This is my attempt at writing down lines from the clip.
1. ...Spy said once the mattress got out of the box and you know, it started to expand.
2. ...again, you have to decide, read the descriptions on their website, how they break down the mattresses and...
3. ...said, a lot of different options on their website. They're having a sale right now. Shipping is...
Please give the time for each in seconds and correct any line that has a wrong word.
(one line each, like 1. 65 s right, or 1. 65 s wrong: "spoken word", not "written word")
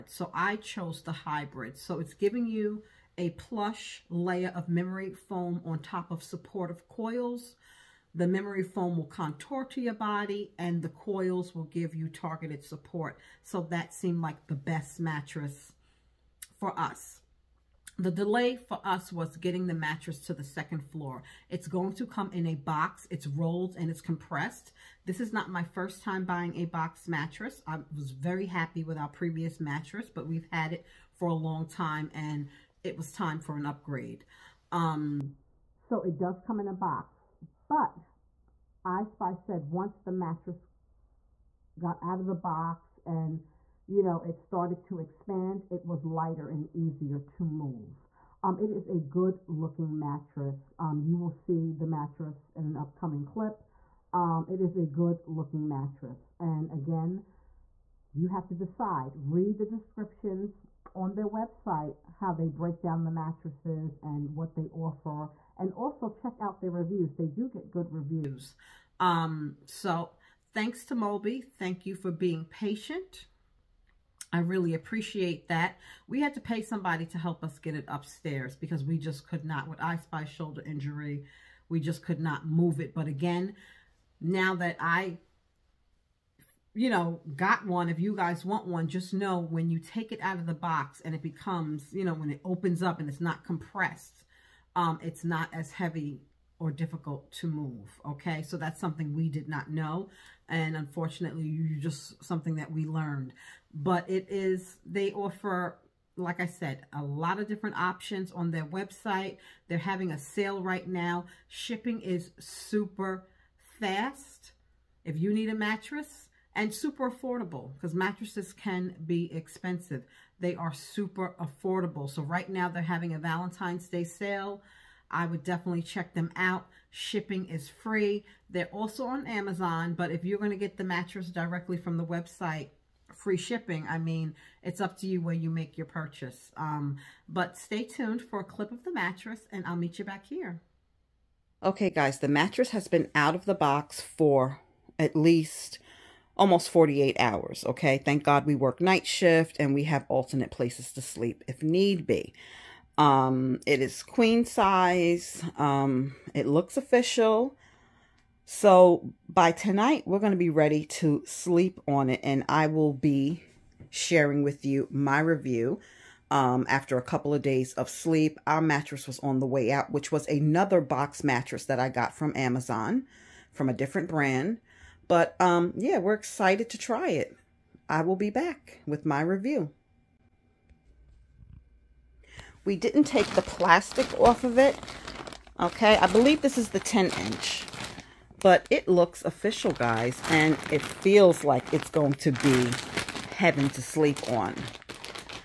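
1. 39 s right
2. 56 s right
3. 106 s right.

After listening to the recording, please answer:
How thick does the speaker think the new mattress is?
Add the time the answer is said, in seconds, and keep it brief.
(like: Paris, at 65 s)
10 inch, at 186 s.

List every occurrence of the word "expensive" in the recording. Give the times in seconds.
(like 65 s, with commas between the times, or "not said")
119 s.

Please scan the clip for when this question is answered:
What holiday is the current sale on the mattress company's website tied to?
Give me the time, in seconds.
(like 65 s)
123 s.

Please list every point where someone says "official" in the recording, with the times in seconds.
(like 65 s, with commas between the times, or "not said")
156 s, 189 s.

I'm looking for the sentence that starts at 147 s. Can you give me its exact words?
Thank God we work night shift and we have alternate places to sleep if need be.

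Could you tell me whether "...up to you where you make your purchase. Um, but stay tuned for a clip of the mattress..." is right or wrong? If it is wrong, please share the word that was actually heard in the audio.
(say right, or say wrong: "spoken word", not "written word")
right.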